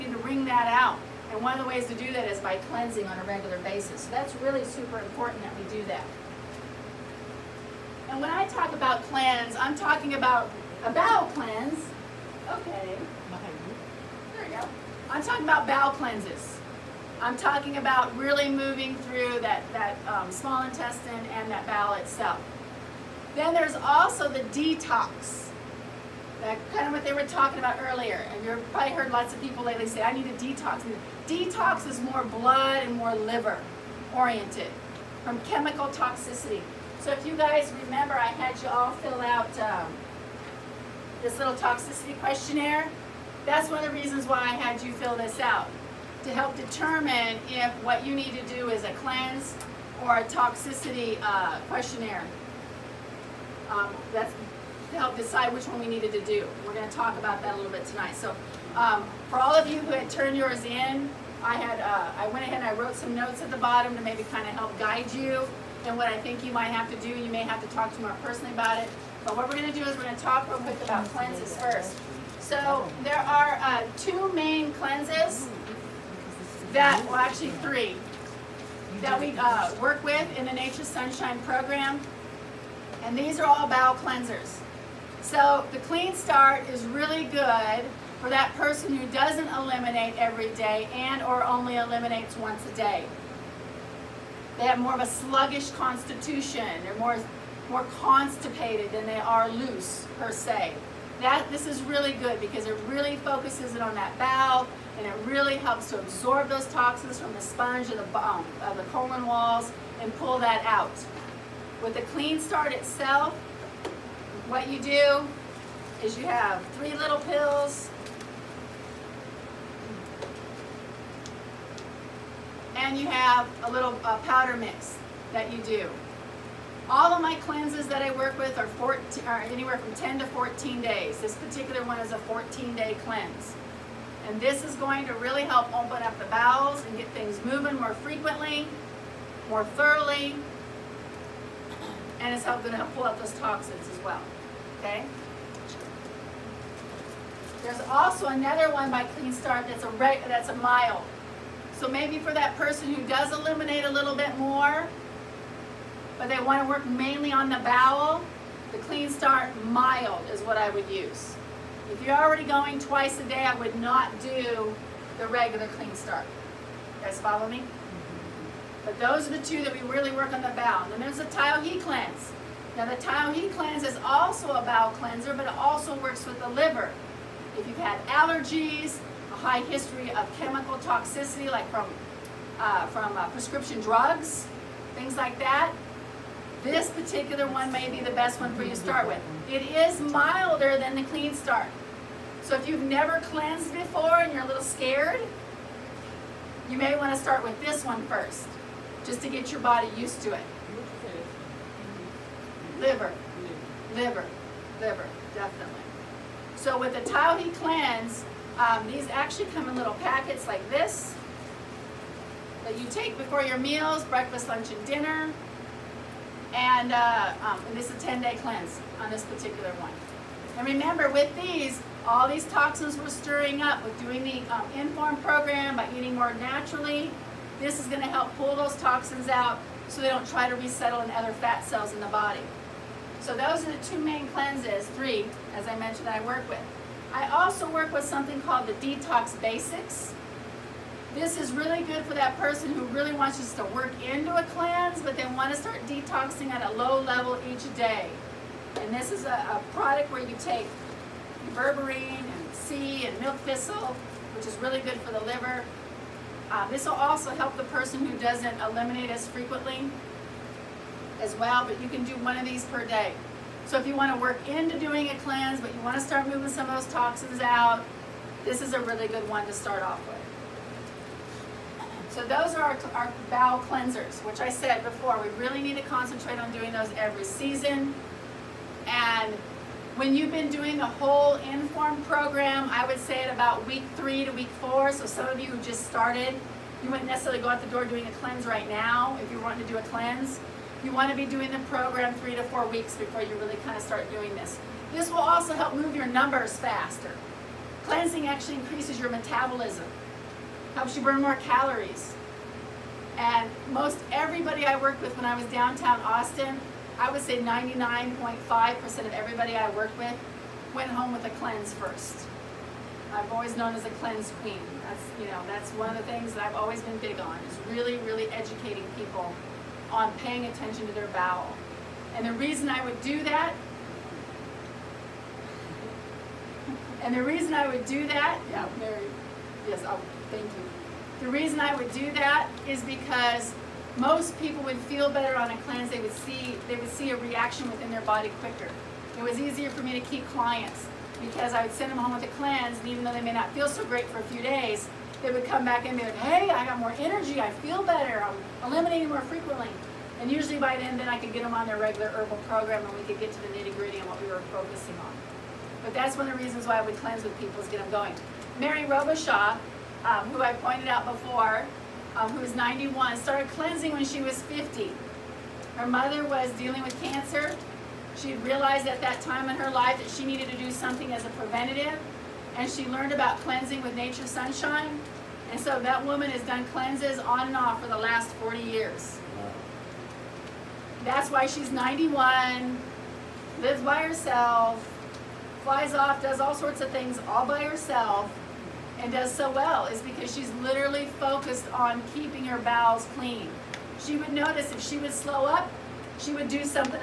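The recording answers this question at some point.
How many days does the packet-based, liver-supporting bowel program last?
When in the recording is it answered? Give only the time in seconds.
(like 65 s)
217 s.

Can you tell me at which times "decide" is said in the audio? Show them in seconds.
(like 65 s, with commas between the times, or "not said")
55 s.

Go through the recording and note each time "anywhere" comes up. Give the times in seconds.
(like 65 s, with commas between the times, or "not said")
129 s.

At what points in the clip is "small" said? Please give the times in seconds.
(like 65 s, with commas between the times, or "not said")
20 s.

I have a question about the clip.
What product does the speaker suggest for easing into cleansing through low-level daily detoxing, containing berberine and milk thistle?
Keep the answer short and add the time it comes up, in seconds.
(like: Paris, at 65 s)
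Detox Basics, at 238 s.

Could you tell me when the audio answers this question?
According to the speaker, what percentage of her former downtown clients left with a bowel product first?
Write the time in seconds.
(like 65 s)
307 s.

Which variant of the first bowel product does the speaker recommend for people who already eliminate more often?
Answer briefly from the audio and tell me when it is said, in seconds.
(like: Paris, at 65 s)
Clean Start mild, at 158 s.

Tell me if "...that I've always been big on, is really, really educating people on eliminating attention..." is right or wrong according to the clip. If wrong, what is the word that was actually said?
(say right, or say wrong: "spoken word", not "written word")
wrong: "paying", not "eliminating".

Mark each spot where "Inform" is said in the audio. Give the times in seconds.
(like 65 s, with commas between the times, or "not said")
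224 s, 281 s.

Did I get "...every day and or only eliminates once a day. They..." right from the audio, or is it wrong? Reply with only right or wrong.
right.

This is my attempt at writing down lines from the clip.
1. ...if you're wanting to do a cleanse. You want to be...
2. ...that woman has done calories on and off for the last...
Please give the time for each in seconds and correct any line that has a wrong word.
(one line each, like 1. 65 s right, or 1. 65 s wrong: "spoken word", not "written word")
1. 289 s right
2. 375 s wrong: "cleanses", not "calories".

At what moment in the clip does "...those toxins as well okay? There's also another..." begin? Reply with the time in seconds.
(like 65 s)
143 s.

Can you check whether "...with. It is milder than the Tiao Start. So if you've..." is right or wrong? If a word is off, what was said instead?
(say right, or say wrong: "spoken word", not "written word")
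wrong: "Clean", not "Tiao".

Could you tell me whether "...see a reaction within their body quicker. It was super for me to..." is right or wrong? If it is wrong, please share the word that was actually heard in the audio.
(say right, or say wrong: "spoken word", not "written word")
wrong: "easier", not "super".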